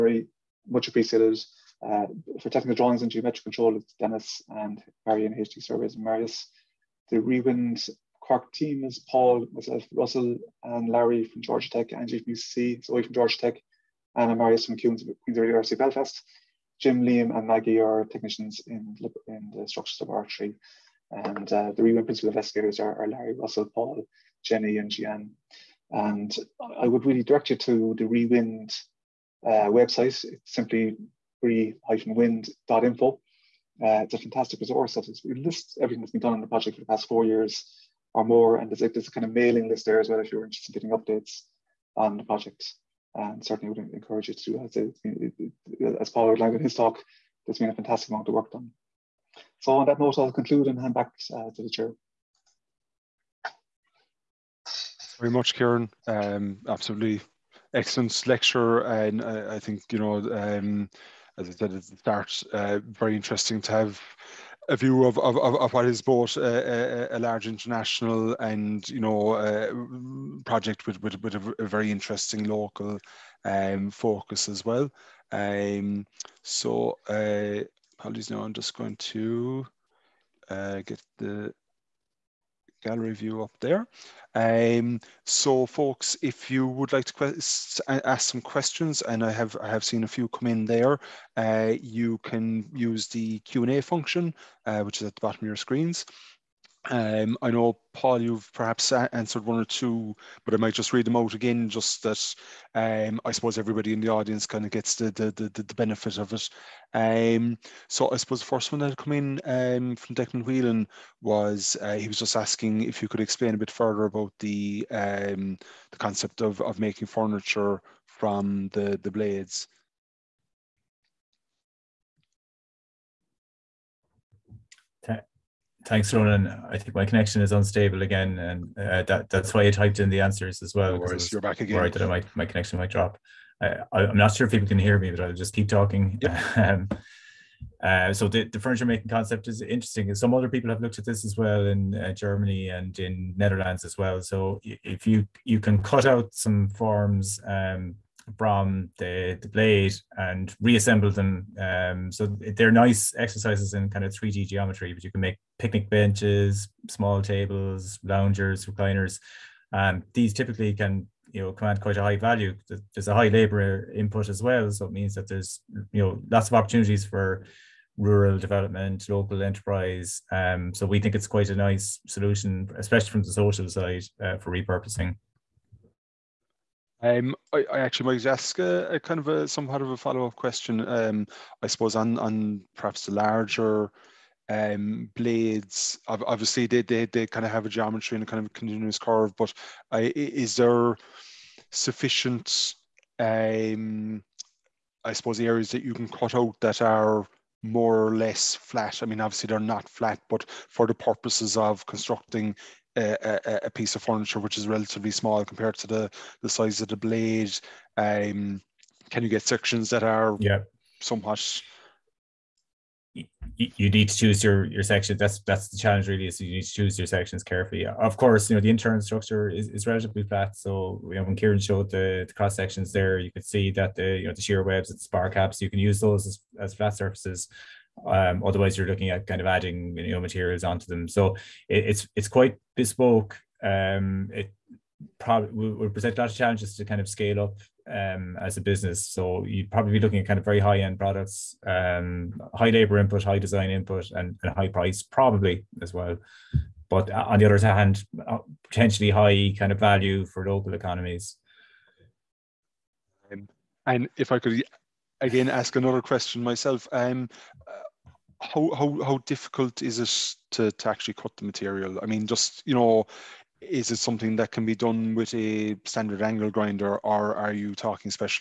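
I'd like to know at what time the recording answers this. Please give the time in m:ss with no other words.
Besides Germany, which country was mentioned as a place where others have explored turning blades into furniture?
2:23.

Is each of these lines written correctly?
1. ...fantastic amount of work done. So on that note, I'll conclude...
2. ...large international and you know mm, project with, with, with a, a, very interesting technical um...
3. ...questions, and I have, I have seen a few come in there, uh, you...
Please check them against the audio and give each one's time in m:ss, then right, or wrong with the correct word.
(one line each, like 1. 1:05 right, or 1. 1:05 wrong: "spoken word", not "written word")
1. 0:47 right
2. 1:07 wrong: "local", not "technical"
3. 1:28 right.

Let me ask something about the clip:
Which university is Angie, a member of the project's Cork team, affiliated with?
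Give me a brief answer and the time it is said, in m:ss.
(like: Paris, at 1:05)
UCC, at 0:11.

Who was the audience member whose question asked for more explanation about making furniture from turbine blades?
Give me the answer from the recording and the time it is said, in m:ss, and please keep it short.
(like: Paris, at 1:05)
Declan Whelan, at 1:50.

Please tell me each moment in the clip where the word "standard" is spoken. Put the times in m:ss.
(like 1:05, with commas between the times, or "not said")
4:25.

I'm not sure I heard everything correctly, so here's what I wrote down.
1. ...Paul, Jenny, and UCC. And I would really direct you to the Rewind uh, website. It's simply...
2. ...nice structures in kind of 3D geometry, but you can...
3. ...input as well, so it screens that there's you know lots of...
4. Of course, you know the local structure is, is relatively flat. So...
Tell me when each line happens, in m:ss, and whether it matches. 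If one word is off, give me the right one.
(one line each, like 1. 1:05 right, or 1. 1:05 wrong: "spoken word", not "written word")
1. 0:23 wrong: "Gian", not "UCC"
2. 2:32 wrong: "exercises", not "structures"
3. 2:43 wrong: "means", not "screens"
4. 3:37 wrong: "internal", not "local".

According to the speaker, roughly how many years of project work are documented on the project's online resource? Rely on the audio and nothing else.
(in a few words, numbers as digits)
4 years.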